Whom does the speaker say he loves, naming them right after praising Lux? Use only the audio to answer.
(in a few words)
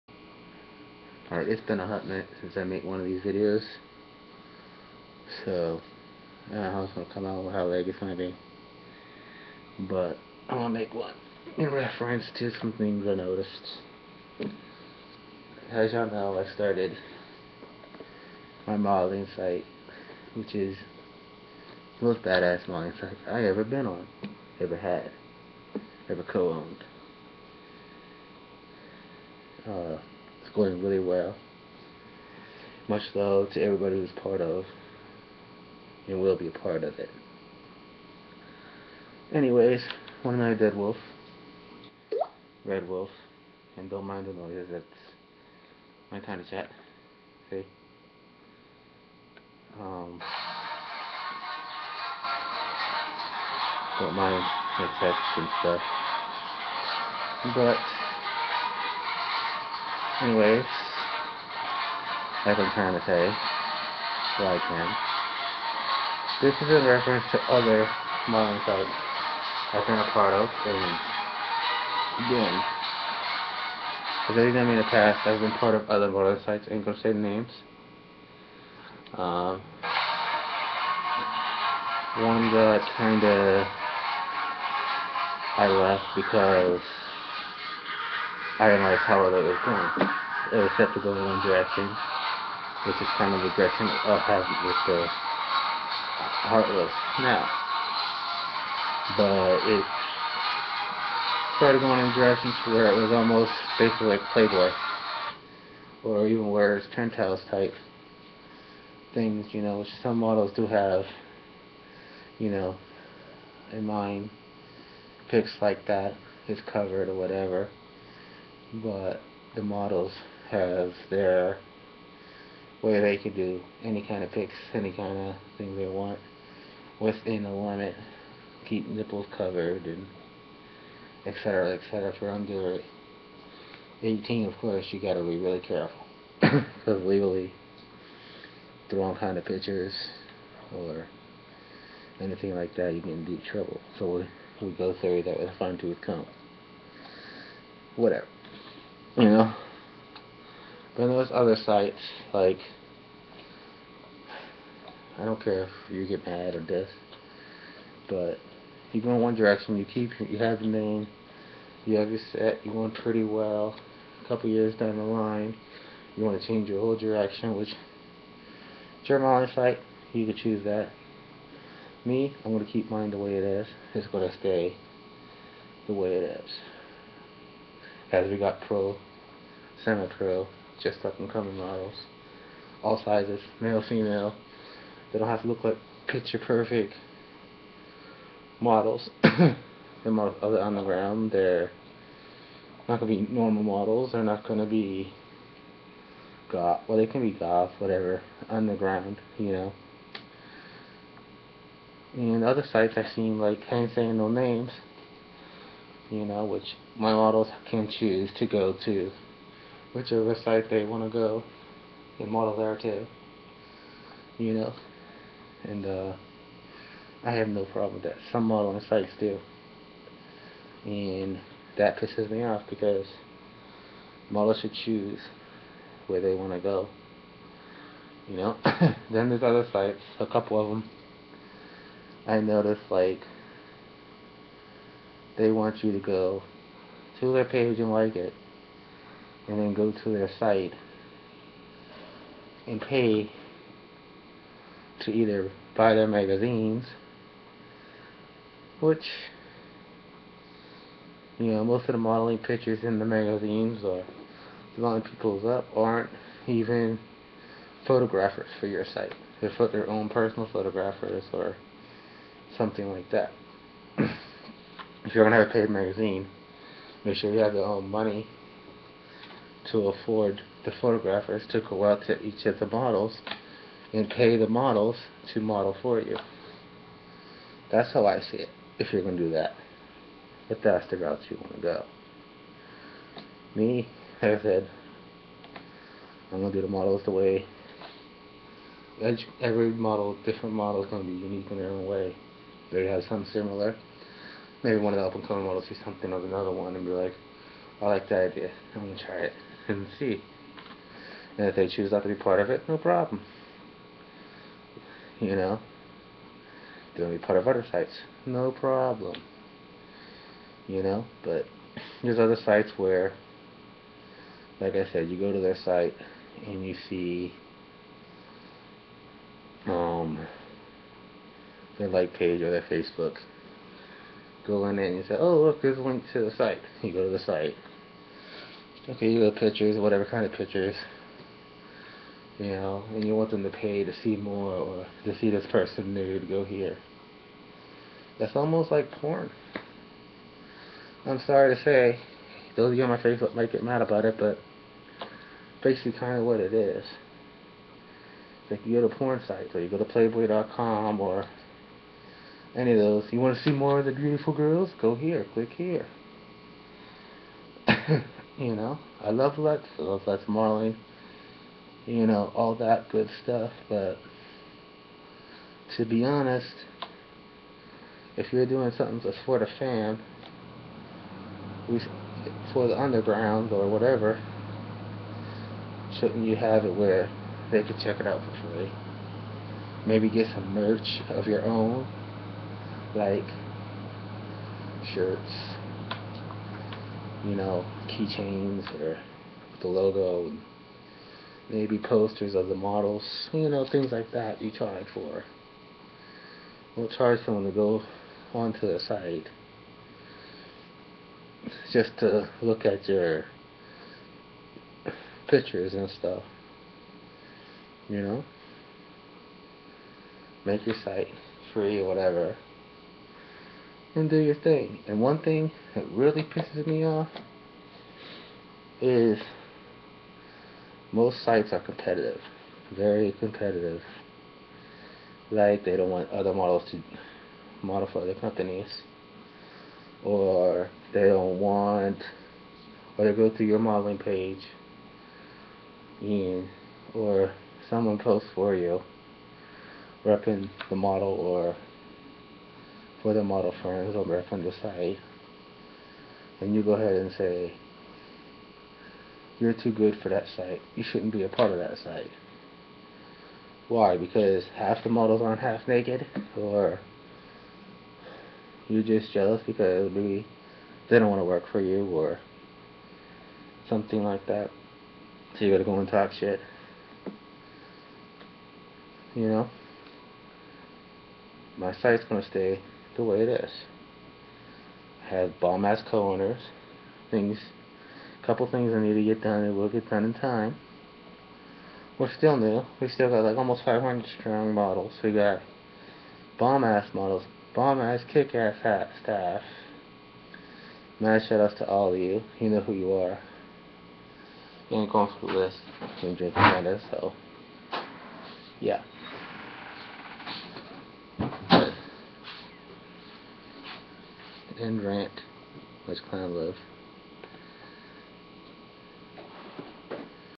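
Lux Marley.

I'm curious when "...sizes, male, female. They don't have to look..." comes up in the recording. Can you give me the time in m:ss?
3:03.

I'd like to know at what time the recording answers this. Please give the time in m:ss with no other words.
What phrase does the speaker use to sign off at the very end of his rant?
8:25.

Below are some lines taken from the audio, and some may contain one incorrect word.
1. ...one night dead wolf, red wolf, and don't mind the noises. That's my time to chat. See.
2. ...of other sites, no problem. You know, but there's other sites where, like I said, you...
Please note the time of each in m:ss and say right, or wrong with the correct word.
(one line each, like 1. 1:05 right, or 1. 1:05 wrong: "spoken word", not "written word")
1. 0:40 right
2. 5:07 right.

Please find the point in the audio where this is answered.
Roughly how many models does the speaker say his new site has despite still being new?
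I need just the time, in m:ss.
8:03.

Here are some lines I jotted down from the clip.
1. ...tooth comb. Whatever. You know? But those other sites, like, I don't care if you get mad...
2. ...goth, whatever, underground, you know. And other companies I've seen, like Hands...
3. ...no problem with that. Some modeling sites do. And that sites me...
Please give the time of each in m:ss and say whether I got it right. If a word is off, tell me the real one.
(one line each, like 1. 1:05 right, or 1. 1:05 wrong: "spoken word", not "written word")
1. 2:25 right
2. 3:17 wrong: "sites", not "companies"
3. 3:37 wrong: "pisses", not "sites".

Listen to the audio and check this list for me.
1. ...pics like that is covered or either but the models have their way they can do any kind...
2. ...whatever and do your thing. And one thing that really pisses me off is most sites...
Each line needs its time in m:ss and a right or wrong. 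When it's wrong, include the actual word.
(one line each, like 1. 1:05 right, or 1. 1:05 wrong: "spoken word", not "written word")
1. 1:55 wrong: "whatever", not "either"
2. 6:51 right.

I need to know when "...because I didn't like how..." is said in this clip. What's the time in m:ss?
1:26.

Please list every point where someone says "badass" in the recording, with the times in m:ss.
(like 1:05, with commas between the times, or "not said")
0:22.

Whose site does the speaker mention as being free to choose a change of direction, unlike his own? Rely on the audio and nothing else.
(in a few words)
Jeremiah.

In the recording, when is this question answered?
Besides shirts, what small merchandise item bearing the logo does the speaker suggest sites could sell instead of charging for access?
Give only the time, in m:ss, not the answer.
6:27.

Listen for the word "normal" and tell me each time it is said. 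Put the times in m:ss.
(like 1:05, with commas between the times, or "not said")
3:13.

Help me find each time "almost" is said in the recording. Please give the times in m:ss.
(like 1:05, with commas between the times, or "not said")
1:43, 5:38, 8:03.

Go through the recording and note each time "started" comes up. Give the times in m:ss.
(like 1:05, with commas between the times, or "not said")
0:16, 1:41.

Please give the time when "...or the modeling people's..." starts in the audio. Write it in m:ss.
4:13.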